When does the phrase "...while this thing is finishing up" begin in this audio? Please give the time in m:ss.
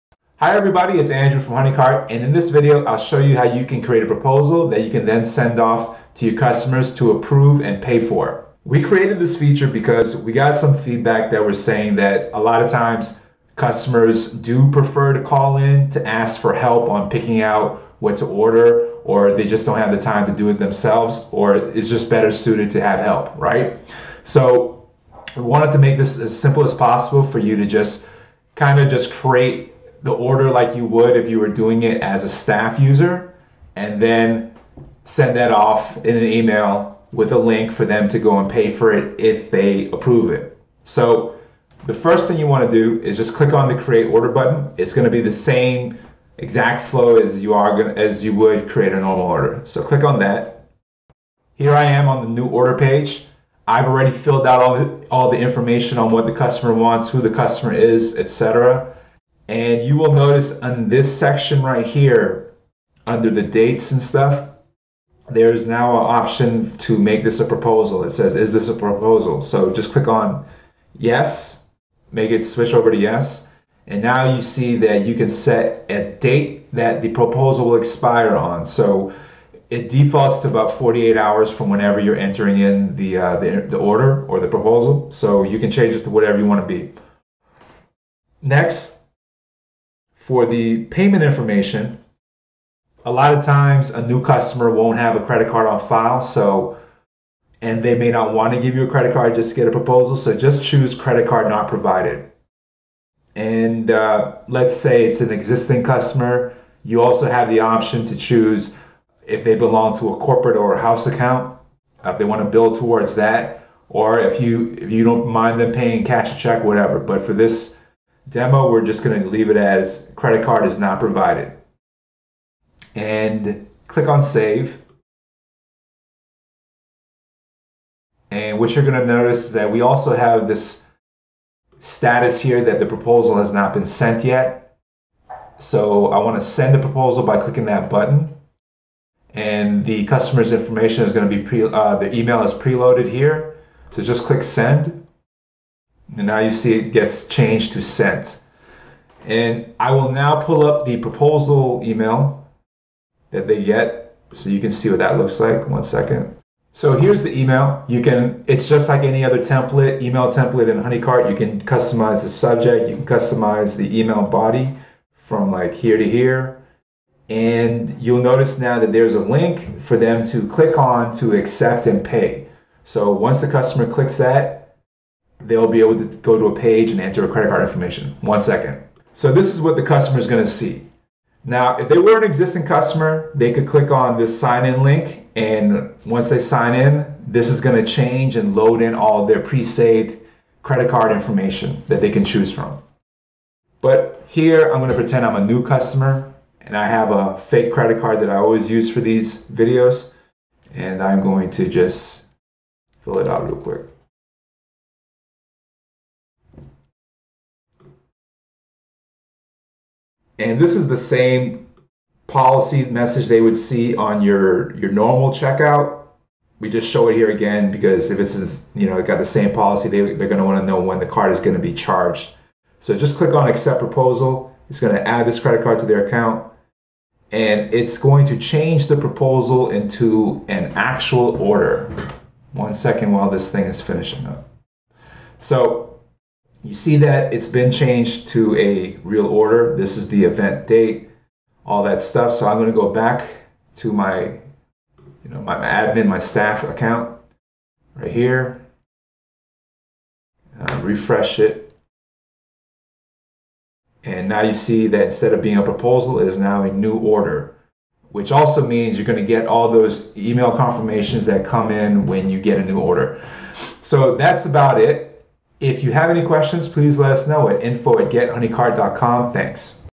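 3:53.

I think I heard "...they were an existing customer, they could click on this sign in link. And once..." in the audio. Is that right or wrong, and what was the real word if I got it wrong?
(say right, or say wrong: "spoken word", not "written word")
right.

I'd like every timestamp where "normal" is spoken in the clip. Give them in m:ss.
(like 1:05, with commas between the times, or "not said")
0:48, 3:34.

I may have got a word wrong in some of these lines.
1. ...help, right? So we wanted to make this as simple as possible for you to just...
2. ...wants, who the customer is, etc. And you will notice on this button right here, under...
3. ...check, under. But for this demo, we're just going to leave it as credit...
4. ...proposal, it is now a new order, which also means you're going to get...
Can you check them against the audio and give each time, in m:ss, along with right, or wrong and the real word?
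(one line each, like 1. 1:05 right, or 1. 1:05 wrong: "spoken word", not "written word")
1. 0:22 right
2. 0:56 wrong: "section", not "button"
3. 1:56 wrong: "whatever", not "under"
4. 4:15 right.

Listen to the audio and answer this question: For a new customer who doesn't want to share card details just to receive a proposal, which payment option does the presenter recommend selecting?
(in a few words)
credit card not provided.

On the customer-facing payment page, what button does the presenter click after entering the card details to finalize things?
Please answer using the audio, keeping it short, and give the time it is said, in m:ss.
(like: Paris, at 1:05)
accept proposal, at 3:43.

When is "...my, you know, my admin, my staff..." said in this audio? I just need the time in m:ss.
4:03.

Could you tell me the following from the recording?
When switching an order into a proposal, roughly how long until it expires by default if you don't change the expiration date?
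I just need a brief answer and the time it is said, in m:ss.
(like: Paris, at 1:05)
48 hours, at 1:20.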